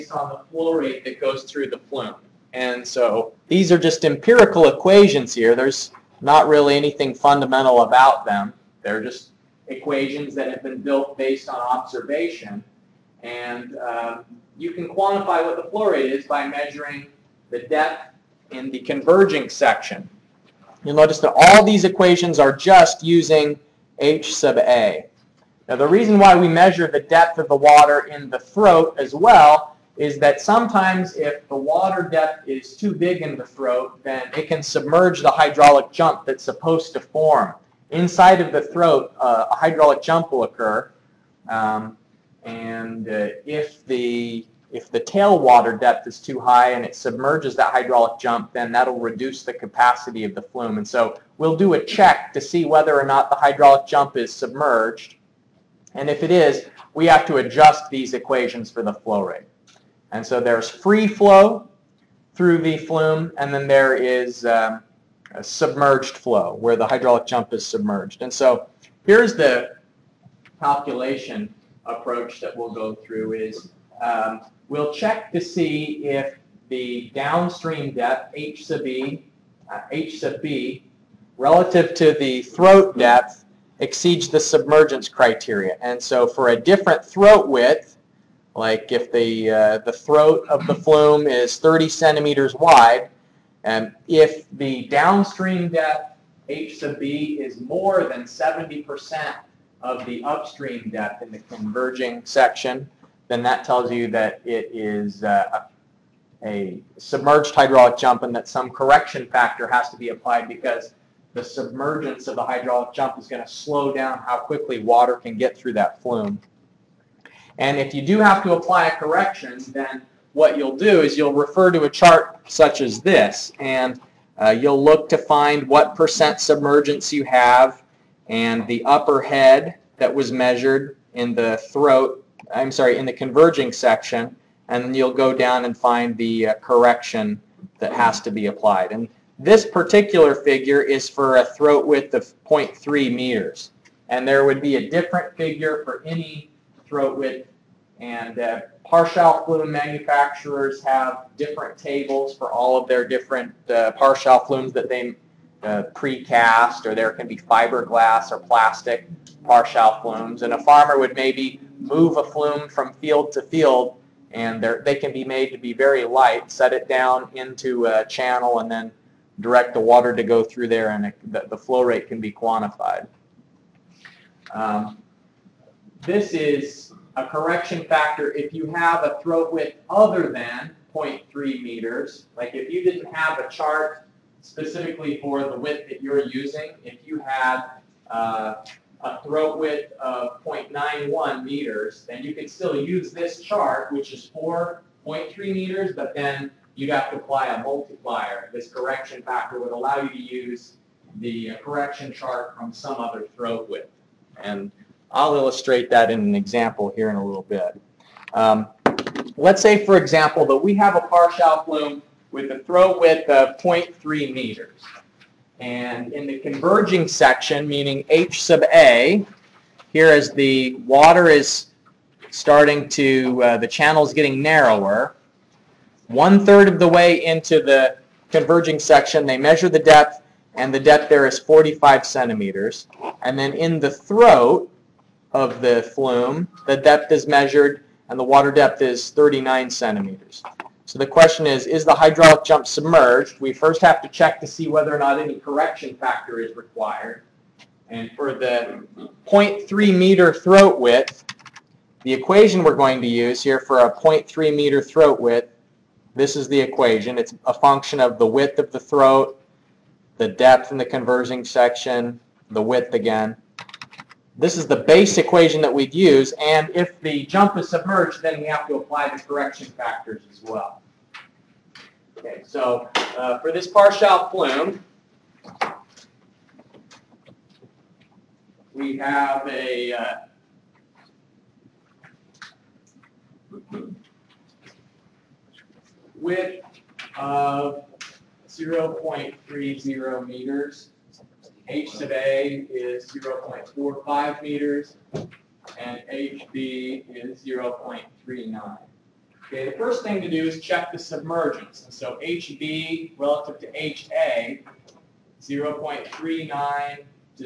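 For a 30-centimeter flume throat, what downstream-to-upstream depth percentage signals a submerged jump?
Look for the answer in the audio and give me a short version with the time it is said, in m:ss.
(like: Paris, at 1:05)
70%, at 1:38.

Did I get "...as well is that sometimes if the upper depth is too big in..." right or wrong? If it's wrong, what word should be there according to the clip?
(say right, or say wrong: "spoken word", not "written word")
wrong: "water", not "upper".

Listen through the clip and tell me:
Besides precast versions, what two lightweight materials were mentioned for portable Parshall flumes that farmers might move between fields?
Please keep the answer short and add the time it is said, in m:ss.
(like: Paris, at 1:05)
fiberglass or plastic, at 2:37.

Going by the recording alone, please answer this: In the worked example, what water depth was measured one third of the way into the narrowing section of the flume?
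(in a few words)
45 centimeters.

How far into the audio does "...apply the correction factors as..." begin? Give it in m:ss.
4:28.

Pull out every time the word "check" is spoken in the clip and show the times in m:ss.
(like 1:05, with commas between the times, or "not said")
0:51, 1:14, 4:04, 5:00.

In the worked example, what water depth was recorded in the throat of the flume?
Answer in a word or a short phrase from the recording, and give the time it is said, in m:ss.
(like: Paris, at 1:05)
39 centimeters, at 3:59.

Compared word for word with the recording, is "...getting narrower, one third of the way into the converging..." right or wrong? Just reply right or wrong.
right.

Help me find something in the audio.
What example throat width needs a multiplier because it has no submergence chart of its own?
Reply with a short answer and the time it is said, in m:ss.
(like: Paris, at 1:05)
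0.91 meters, at 3:10.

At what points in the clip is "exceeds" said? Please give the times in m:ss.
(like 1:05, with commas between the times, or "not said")
1:23.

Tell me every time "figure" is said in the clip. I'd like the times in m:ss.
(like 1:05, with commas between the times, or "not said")
2:20, 2:25.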